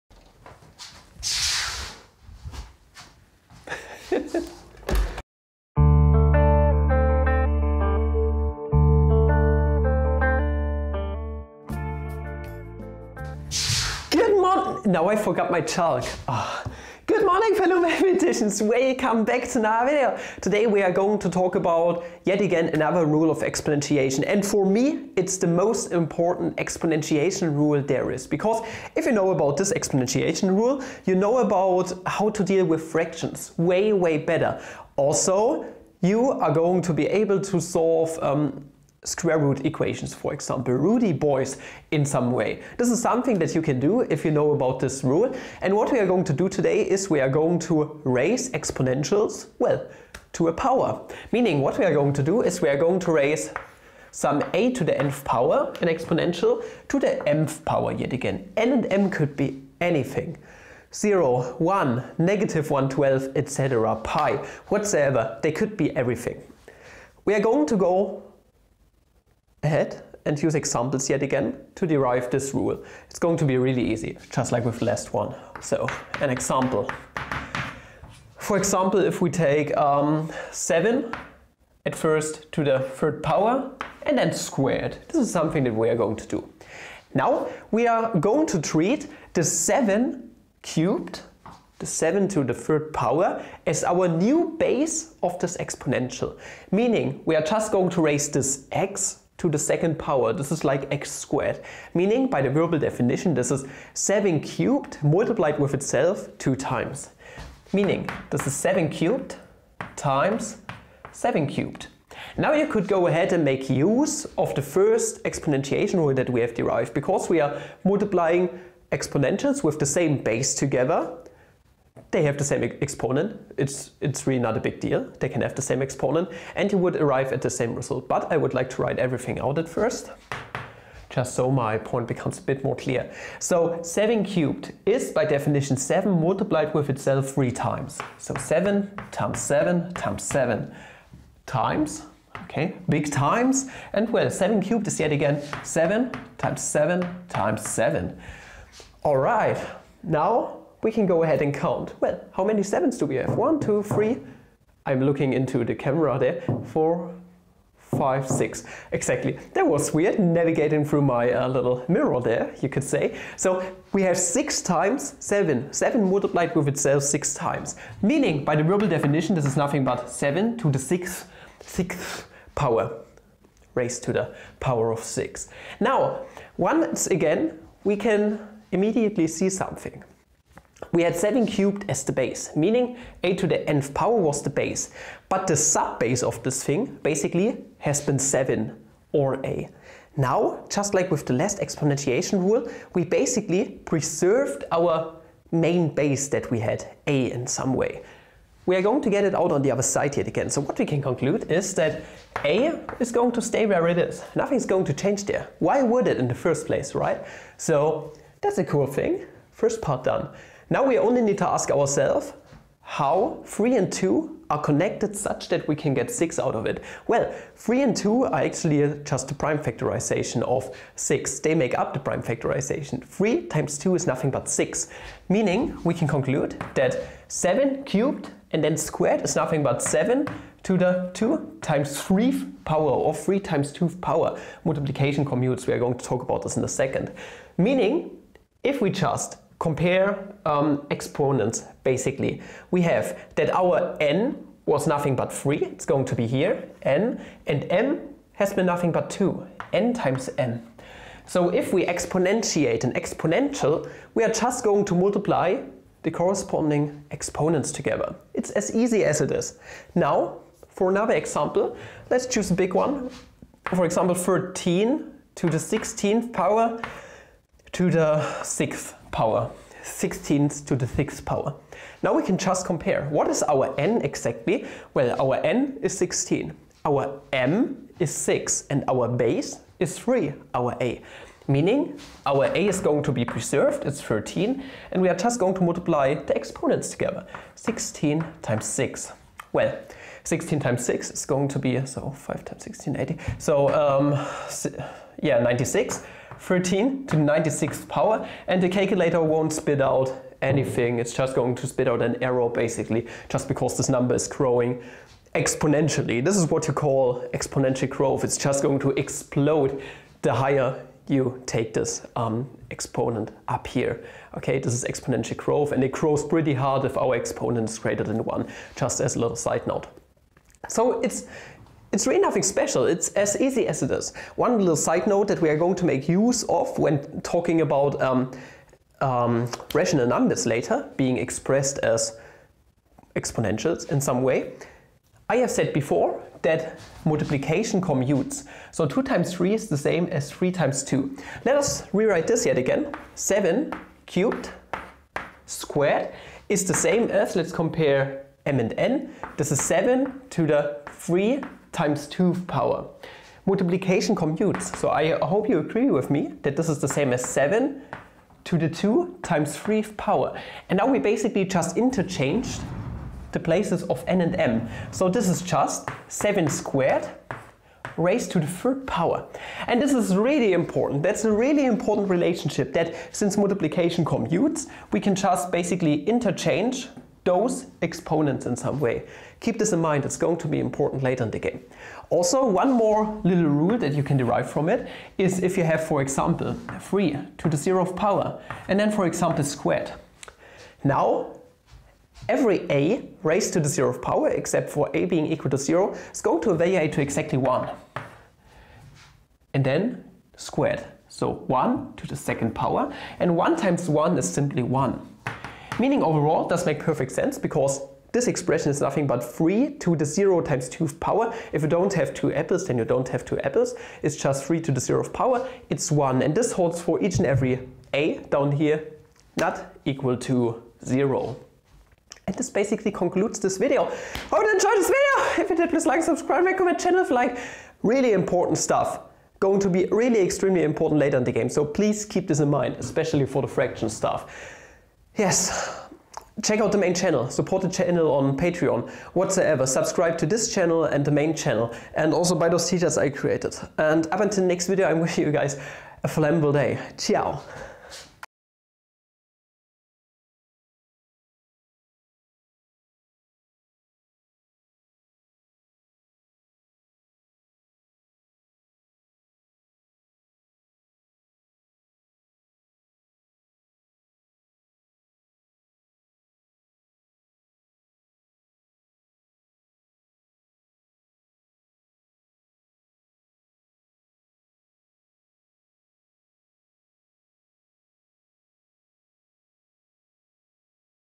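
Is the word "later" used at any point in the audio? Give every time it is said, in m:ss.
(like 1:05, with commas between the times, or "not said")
5:30, 6:21, 7:10.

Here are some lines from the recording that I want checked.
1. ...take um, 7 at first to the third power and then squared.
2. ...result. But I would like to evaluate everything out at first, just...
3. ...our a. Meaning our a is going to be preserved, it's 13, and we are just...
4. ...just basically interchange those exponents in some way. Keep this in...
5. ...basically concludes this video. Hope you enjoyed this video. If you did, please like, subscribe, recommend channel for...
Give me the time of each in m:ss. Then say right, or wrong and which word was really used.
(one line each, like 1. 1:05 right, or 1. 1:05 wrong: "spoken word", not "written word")
1. 1:19 right
2. 2:07 wrong: "write", not "evaluate"
3. 4:40 right
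4. 6:15 right
5. 7:02 right.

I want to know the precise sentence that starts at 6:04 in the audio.
So this is just 7 squared raised to the third power.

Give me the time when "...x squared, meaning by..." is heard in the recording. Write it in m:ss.
1:40.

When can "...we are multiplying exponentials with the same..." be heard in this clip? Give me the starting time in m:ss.
1:57.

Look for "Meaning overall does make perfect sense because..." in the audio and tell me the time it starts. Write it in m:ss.
6:45.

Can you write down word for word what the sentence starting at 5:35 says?
I have said before that multiplication commutes.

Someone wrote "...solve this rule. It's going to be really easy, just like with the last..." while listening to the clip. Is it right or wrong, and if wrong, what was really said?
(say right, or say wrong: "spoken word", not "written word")
wrong: "derive", not "solve".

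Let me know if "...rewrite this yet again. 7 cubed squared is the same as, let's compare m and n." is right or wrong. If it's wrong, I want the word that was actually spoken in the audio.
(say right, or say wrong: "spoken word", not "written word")
right.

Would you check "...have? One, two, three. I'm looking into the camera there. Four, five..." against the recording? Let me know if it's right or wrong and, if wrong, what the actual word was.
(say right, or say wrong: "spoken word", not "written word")
right.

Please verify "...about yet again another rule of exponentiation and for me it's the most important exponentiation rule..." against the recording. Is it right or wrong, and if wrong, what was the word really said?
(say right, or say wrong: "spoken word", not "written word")
right.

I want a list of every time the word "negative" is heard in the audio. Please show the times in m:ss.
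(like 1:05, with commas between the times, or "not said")
1:02.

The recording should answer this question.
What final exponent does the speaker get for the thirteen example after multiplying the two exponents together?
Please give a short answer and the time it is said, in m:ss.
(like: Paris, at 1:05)
96, at 4:57.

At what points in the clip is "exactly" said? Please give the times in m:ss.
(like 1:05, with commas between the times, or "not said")
2:38, 4:34, 6:37.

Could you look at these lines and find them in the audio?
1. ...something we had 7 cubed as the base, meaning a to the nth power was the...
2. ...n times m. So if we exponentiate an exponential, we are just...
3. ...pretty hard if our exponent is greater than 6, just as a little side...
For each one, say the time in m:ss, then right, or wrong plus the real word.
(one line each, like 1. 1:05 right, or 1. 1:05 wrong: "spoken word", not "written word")
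1. 2:59 right
2. 4:09 right
3. 5:16 wrong: "1", not "6".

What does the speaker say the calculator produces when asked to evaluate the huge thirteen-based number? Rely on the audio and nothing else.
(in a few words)
an error.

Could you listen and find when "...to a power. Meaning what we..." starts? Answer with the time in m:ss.
0:50.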